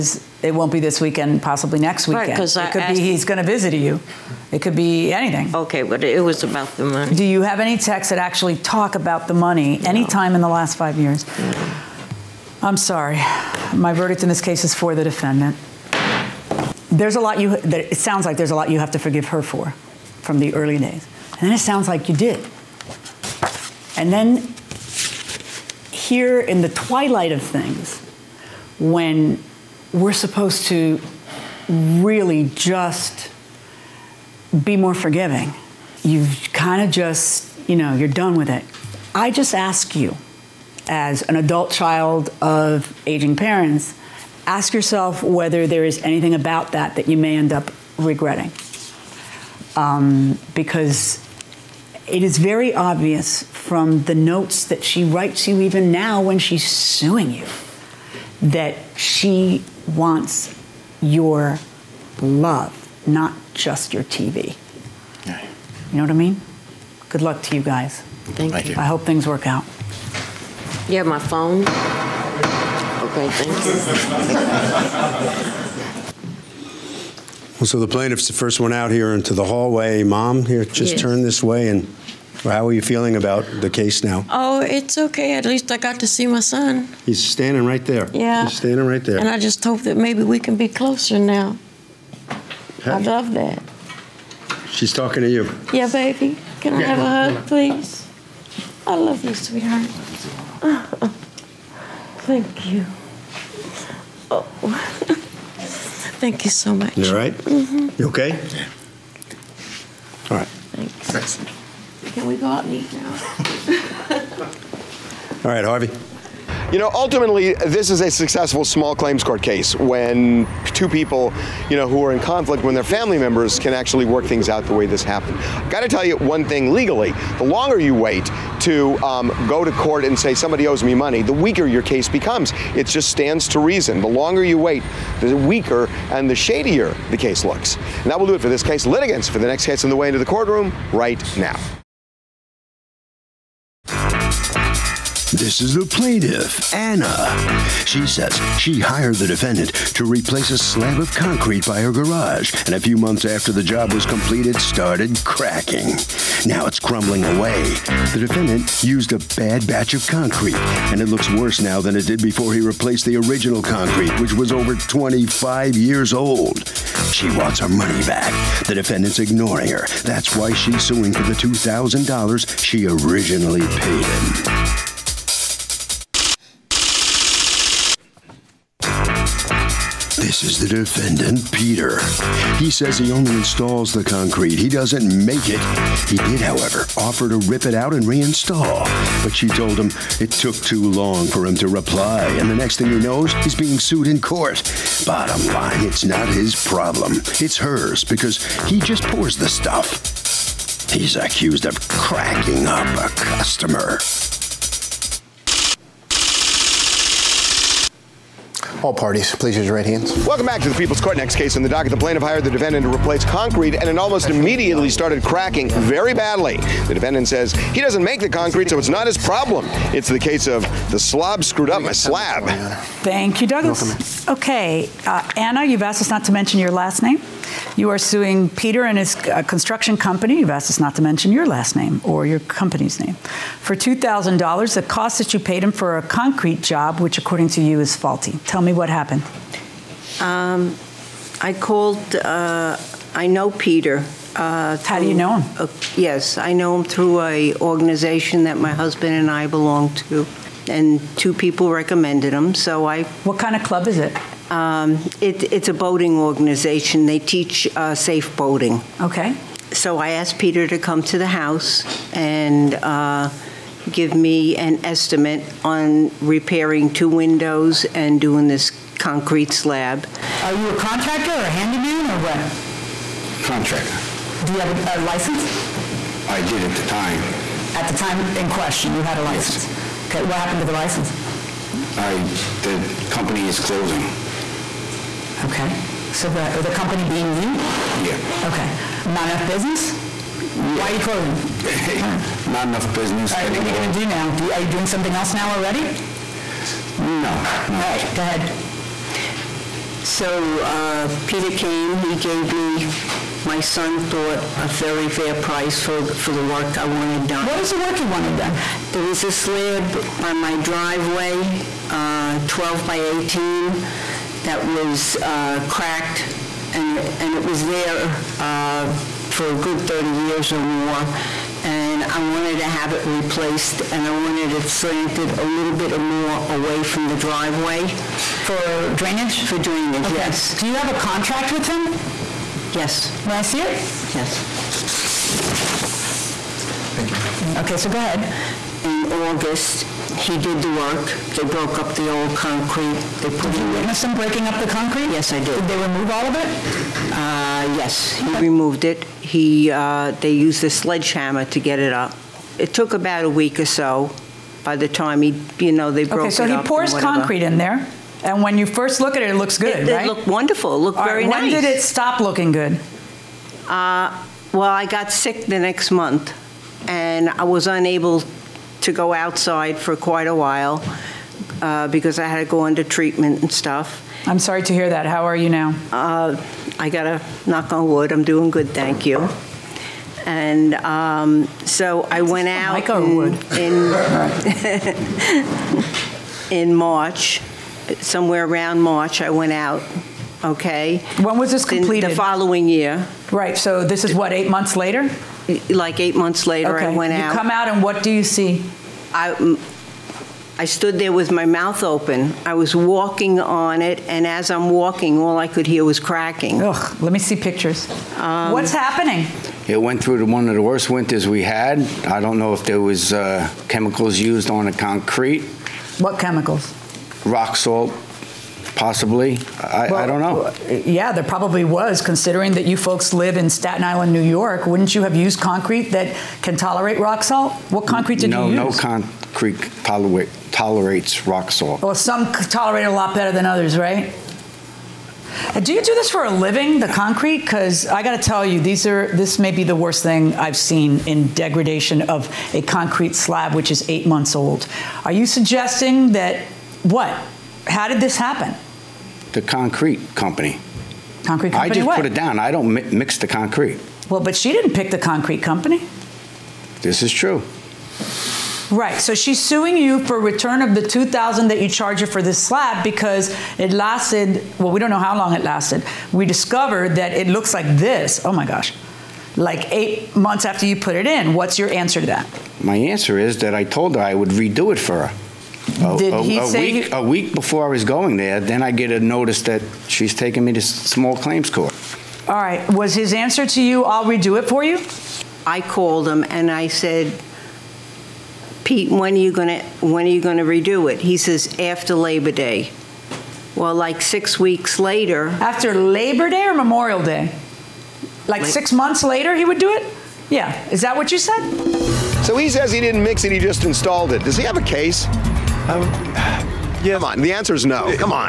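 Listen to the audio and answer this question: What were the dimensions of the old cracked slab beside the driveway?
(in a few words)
12 by 18.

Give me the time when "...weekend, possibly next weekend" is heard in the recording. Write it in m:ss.
0:01.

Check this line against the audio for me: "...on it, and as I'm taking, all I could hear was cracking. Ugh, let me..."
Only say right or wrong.
wrong.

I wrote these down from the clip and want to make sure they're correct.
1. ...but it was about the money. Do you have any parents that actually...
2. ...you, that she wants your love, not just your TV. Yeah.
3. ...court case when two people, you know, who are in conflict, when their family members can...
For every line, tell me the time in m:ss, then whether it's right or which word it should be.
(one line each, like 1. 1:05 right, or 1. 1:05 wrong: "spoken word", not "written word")
1. 0:05 wrong: "texts", not "parents"
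2. 0:57 right
3. 1:59 right.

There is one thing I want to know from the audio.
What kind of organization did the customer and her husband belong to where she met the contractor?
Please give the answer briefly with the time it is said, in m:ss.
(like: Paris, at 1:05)
A boating organization, at 4:15.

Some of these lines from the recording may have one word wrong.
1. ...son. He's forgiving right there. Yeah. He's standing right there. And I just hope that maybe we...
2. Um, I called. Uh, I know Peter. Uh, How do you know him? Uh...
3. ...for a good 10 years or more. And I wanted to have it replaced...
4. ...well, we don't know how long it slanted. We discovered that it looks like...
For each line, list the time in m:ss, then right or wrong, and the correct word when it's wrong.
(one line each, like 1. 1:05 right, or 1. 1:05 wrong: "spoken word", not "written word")
1. 1:26 wrong: "standing", not "forgiving"
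2. 4:00 right
3. 5:19 wrong: "30", not "10"
4. 7:44 wrong: "lasted", not "slanted".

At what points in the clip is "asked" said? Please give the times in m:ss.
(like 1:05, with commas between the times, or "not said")
3:45, 3:50, 4:20.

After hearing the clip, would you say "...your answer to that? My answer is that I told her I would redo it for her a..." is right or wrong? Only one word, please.
right.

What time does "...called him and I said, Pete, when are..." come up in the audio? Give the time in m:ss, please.
8:05.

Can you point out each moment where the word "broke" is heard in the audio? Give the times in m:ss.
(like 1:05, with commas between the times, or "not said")
5:41, 5:56.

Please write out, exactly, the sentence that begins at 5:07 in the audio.
What is the work he wanted done?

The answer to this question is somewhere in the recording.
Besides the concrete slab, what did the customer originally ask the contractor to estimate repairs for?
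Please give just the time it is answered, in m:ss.
4:26.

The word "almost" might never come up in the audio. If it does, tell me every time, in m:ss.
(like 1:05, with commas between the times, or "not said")
3:33.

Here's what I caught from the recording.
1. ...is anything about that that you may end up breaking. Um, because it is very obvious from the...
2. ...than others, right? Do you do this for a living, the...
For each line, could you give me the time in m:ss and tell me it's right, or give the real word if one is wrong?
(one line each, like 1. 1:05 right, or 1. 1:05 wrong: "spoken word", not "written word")
1. 0:45 wrong: "regretting", not "breaking"
2. 7:13 right.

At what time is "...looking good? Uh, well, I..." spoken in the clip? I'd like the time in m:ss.
6:02.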